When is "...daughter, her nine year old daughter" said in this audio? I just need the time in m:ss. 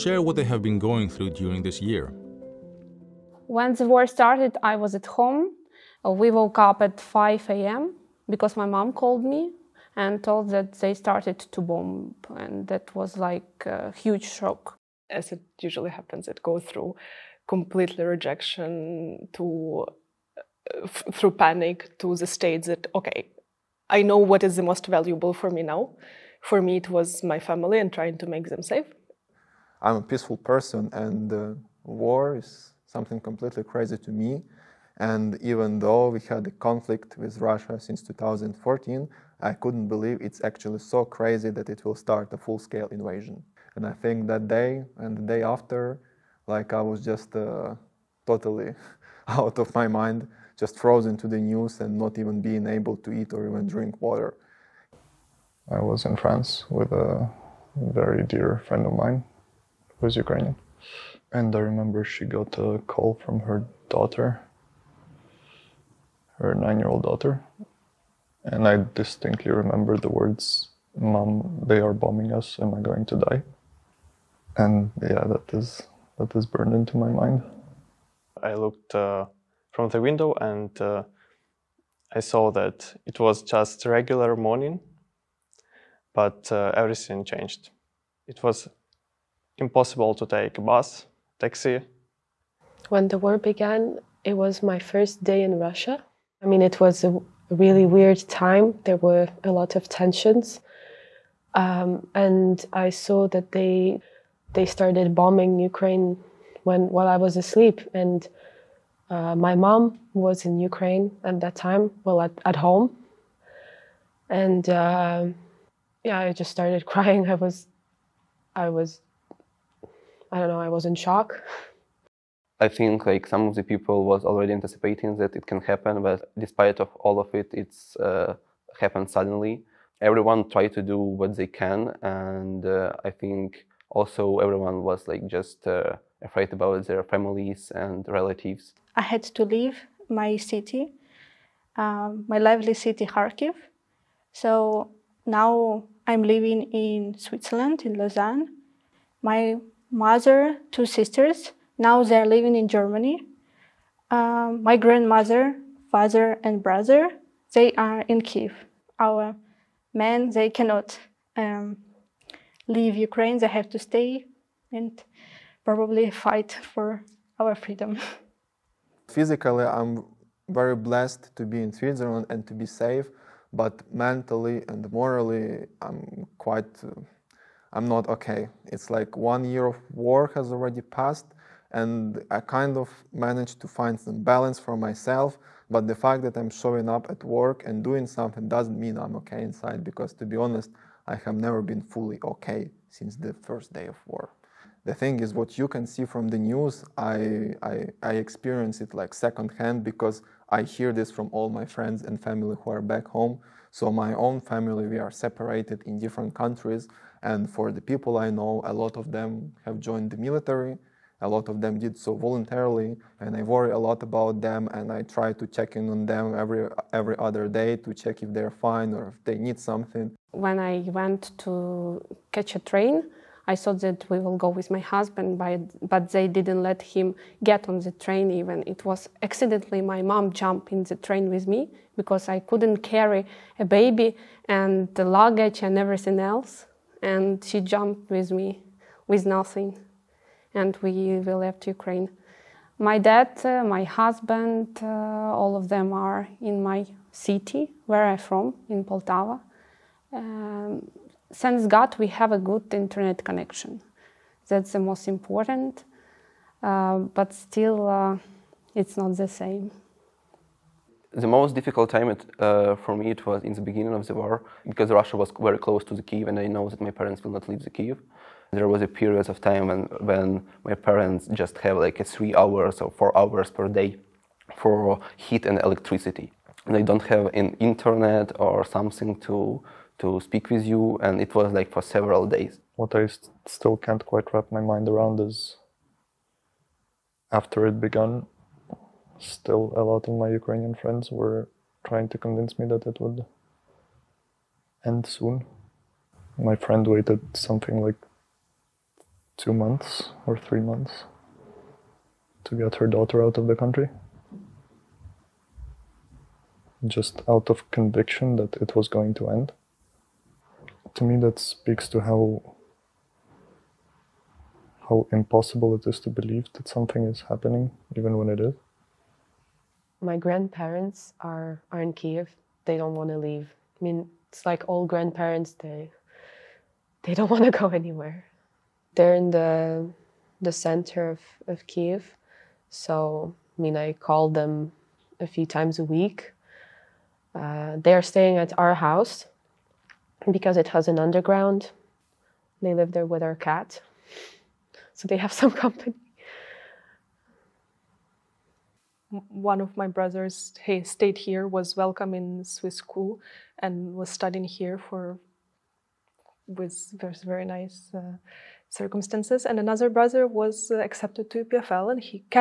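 1:03.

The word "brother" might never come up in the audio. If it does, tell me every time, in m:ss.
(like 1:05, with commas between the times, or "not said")
2:36, 5:49, 5:59.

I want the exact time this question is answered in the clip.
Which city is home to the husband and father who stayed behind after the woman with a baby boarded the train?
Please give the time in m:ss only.
4:08.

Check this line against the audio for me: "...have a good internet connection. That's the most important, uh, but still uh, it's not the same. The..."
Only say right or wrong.
right.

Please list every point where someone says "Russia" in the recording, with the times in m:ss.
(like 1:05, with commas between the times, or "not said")
0:37, 1:35, 4:24.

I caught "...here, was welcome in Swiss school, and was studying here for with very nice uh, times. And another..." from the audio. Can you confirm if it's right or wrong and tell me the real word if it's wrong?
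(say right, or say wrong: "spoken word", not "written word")
wrong: "circumstances", not "times".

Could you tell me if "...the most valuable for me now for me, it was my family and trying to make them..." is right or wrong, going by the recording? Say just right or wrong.
right.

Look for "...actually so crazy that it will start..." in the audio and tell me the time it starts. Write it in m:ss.
0:40.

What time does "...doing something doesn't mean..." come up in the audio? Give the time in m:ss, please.
3:07.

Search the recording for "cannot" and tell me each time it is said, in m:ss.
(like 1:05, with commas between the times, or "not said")
2:40.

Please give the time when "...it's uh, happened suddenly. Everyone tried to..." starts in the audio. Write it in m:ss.
2:07.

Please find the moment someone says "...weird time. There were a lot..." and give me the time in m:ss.
1:37.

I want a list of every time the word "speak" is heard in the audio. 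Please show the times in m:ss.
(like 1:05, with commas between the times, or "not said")
4:40, 5:11.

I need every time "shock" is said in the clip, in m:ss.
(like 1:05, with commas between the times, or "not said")
0:14, 2:00.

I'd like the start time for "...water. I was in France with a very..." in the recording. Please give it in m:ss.
0:54.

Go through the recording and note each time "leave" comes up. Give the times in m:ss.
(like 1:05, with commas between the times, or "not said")
2:19, 2:42, 4:27, 5:23.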